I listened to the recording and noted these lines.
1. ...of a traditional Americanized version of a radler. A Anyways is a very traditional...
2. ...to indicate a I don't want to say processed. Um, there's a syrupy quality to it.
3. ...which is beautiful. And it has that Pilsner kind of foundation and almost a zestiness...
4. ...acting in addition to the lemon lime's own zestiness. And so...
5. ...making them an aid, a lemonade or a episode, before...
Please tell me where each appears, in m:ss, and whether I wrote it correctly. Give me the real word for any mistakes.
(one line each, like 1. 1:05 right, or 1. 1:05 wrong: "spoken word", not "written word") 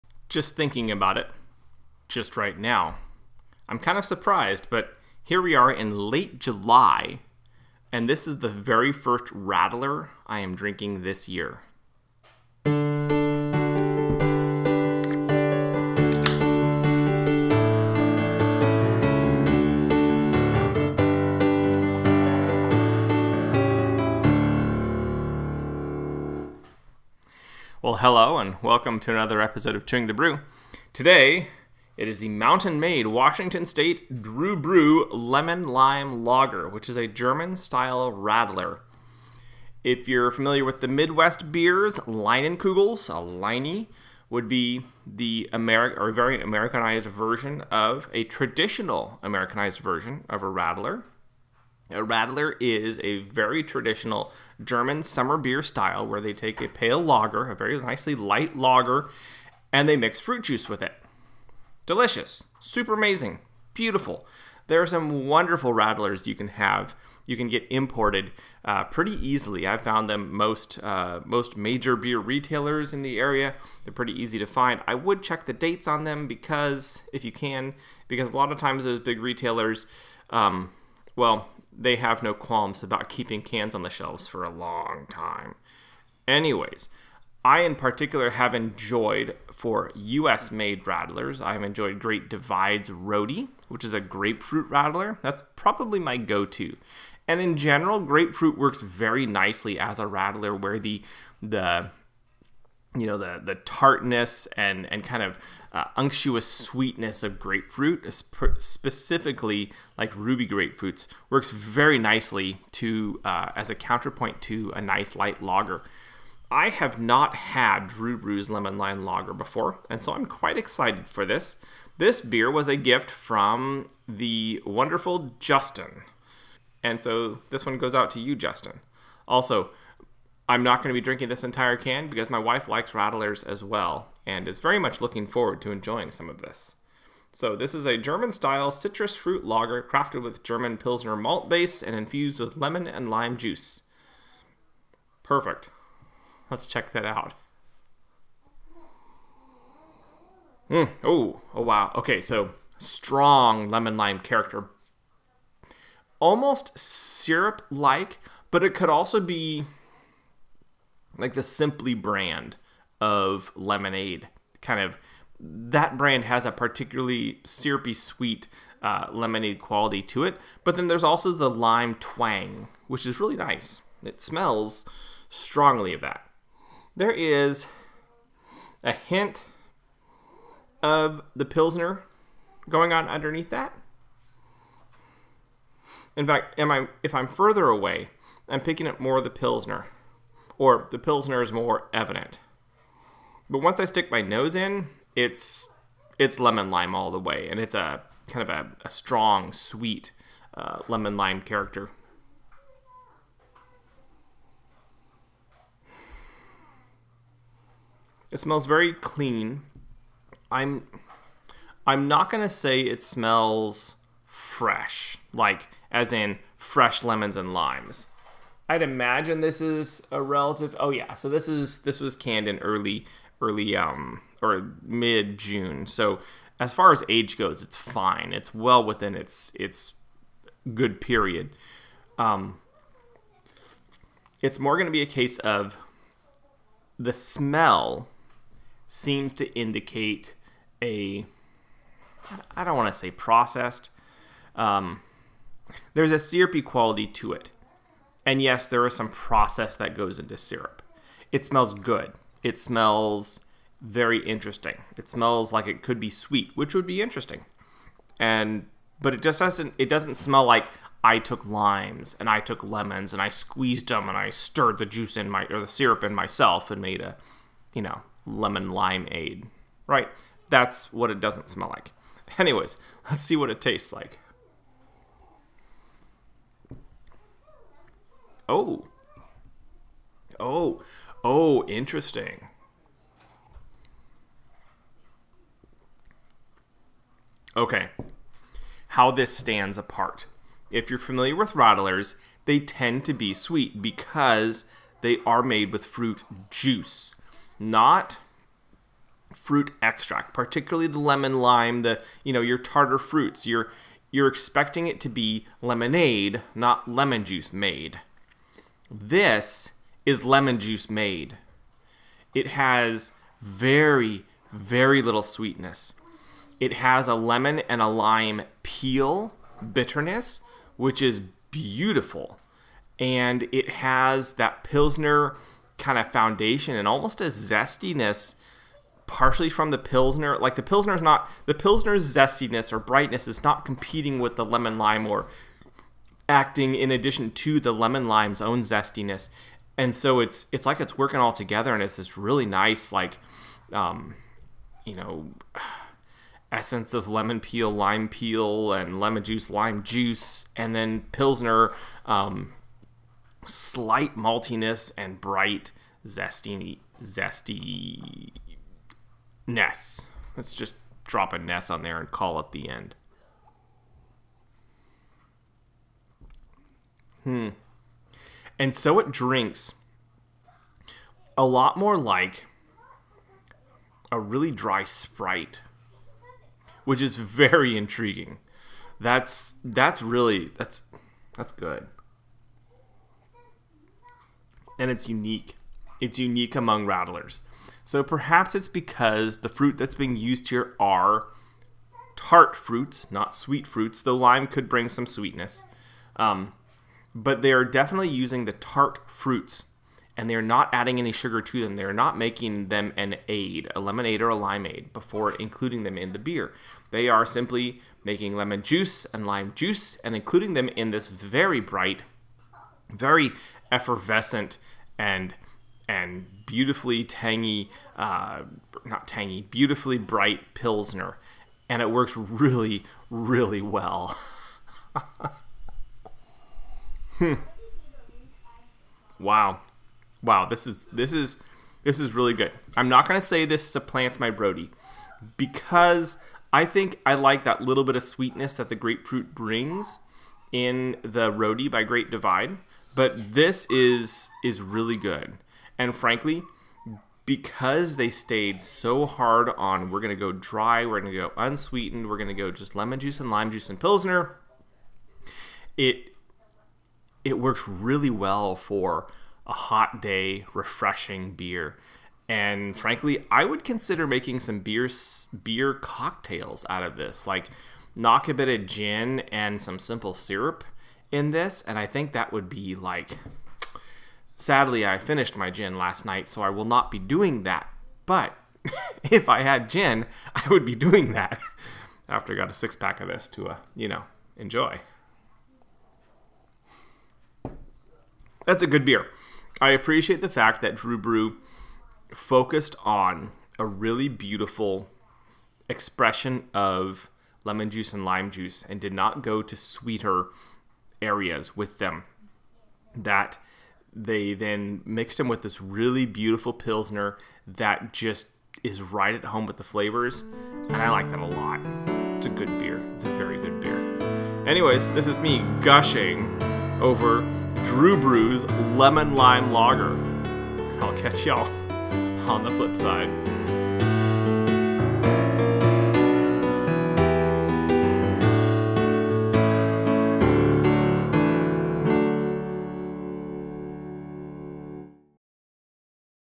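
1. 0:47 wrong: "Radler", not "Anyways"
2. 3:59 right
3. 5:20 right
4. 5:36 right
5. 6:42 wrong: "limeade", not "episode".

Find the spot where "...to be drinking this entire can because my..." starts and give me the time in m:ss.
2:10.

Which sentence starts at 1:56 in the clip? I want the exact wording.
I have not had Dru Bru's Lemon Lime Lager before, and so I'm quite excited for this.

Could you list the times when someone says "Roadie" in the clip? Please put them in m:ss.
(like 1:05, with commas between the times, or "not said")
1:32, 7:14, 7:21.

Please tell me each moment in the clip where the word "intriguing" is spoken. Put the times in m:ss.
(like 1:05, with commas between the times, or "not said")
6:17.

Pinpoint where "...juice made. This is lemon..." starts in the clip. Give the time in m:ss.
5:07.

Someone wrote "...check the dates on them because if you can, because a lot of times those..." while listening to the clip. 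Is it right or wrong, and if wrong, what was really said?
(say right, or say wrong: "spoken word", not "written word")
right.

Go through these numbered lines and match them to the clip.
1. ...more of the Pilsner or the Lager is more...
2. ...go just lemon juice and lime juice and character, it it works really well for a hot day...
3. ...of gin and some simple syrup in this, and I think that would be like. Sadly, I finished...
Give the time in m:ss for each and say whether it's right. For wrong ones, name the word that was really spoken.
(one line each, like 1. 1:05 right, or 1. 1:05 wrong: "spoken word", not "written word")
1. 3:08 wrong: "Pilsner", not "Lager"
2. 7:32 wrong: "pilsner", not "character"
3. 7:48 right.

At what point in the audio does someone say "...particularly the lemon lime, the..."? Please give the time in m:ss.
5:00.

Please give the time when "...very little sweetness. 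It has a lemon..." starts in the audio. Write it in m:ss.
5:14.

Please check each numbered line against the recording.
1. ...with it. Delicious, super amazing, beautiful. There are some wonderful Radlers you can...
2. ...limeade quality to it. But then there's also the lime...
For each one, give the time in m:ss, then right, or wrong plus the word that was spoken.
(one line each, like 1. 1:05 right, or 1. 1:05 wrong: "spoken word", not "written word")
1. 1:00 right
2. 2:49 wrong: "lemonade", not "limeade".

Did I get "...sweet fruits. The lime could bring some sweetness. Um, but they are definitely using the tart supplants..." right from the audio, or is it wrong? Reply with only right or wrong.
wrong.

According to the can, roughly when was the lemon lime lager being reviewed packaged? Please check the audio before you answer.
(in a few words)
mid June.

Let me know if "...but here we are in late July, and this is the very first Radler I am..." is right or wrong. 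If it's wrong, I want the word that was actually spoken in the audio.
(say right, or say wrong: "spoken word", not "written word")
right.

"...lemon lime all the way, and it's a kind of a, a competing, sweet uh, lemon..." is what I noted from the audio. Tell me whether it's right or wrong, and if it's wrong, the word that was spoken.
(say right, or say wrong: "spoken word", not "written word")
wrong: "strong", not "competing".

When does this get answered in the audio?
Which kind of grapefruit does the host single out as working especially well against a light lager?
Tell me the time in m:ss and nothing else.
1:50.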